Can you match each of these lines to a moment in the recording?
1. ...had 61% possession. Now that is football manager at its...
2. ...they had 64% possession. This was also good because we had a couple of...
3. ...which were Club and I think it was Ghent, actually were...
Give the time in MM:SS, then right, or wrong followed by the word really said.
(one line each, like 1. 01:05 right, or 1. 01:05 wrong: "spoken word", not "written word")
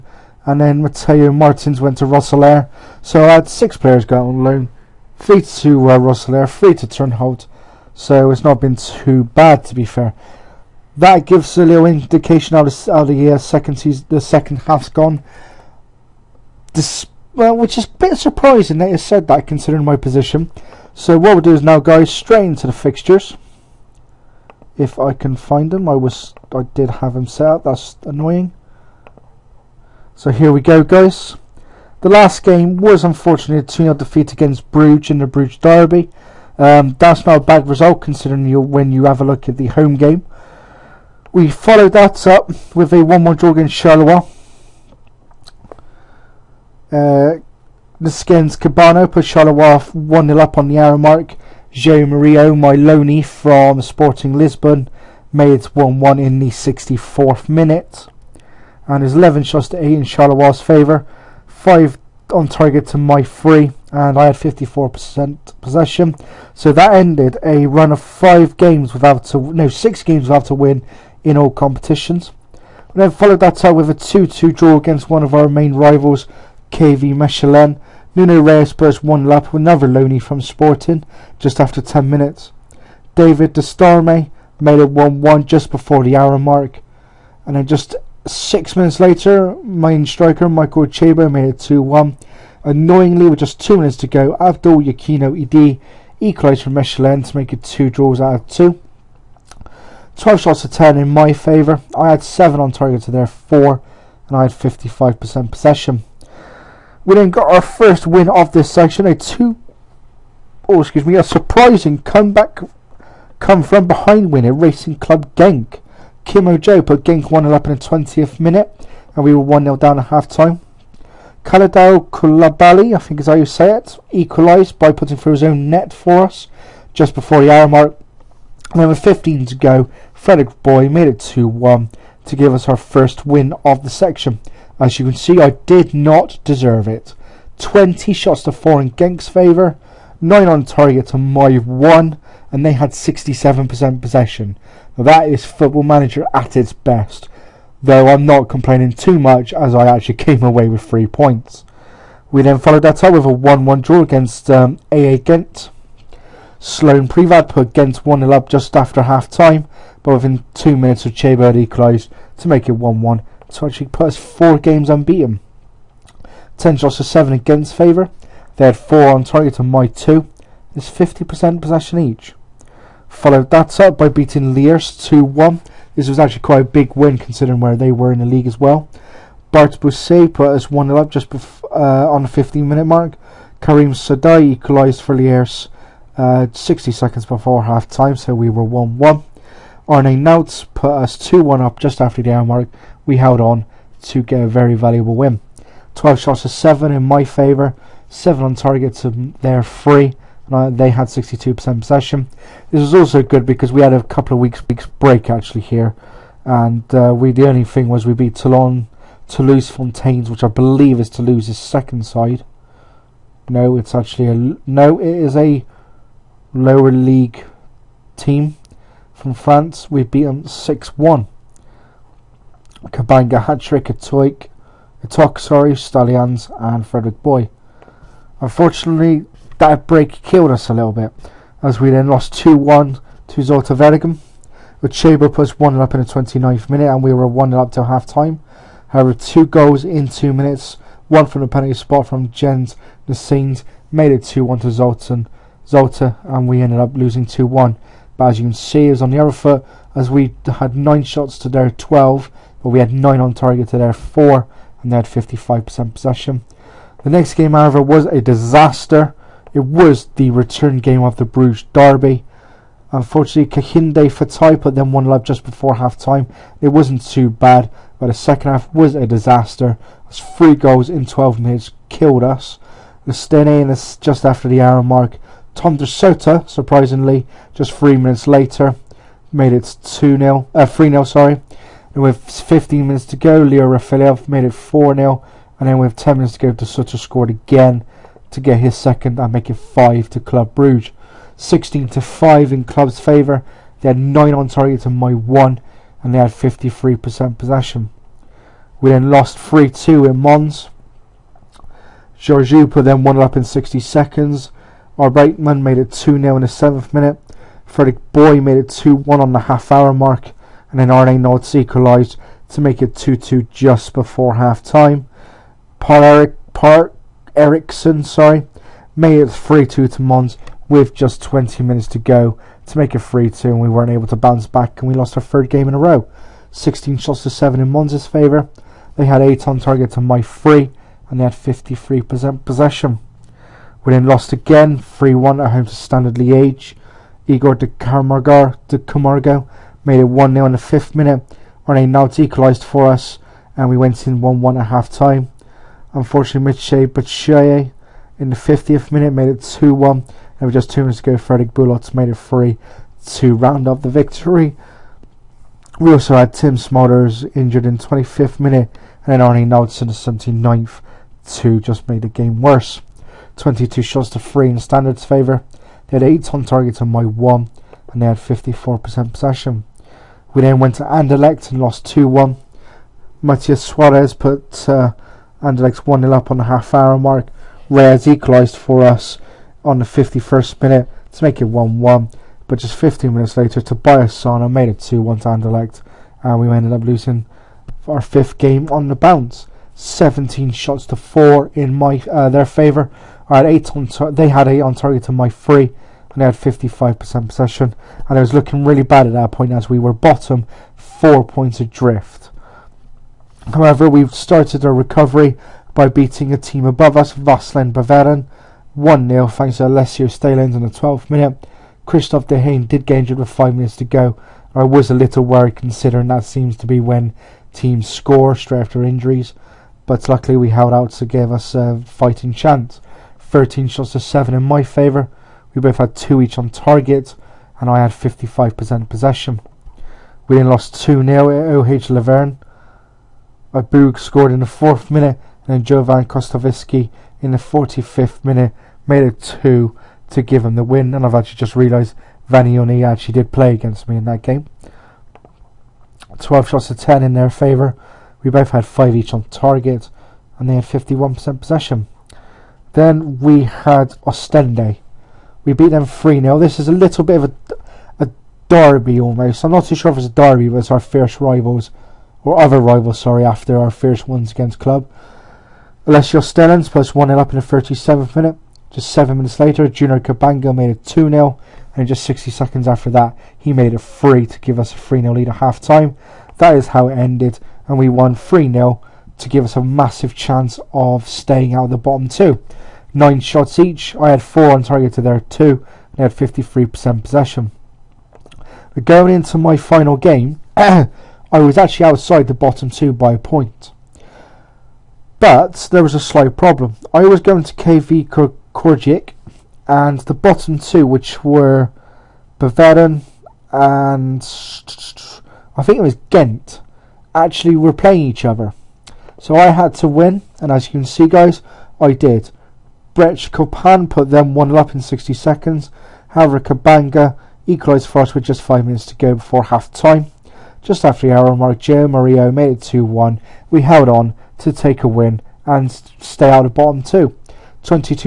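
1. 02:22 wrong: "67", not "61"
2. 03:20 wrong: "62", not "64"
3. 08:20 wrong: "Bavarian", not "Club".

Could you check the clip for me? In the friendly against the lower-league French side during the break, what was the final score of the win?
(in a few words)
6-1.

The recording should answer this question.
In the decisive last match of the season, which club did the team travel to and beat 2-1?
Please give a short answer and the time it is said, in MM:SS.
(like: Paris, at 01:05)
KV Kortrijk, at 08:17.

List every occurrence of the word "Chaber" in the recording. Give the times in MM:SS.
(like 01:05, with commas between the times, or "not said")
03:54.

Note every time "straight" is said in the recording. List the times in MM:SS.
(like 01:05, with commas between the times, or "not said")
00:22, 06:58.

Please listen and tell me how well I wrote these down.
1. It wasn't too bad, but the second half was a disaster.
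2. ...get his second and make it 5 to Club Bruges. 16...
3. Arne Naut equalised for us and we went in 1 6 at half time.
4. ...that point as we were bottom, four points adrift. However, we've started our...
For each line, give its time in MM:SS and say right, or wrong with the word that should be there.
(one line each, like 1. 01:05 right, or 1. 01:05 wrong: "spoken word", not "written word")
1. 04:26 right
2. 04:48 right
3. 05:41 wrong: "1", not "6"
4. 06:39 right.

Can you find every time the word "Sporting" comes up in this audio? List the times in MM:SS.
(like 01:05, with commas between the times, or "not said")
00:53, 01:20.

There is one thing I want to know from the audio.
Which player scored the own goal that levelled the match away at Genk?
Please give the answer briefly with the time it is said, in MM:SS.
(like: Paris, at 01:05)
Kalidou Koulibaly, at 02:01.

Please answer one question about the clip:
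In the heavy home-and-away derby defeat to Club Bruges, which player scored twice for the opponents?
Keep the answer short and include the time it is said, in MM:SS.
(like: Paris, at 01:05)
Tom De Sutter, at 04:35.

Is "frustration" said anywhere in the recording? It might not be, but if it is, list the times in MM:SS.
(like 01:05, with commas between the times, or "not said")
not said.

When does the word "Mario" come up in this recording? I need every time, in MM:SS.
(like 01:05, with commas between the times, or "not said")
00:52, 08:41.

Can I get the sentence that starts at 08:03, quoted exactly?
I had four on target to their two.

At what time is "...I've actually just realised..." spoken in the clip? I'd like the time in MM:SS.
07:21.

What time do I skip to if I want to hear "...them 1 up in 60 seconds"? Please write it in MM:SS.
08:34.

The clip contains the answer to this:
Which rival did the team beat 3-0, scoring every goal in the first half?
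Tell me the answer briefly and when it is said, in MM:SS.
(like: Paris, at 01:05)
Ostende, at 07:34.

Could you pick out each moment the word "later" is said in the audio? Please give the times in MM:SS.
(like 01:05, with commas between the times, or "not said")
01:28, 04:38, 06:23, 07:49.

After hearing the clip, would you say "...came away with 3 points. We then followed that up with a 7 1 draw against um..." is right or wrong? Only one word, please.
wrong.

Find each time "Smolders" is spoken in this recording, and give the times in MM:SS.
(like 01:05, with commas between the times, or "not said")
05:56.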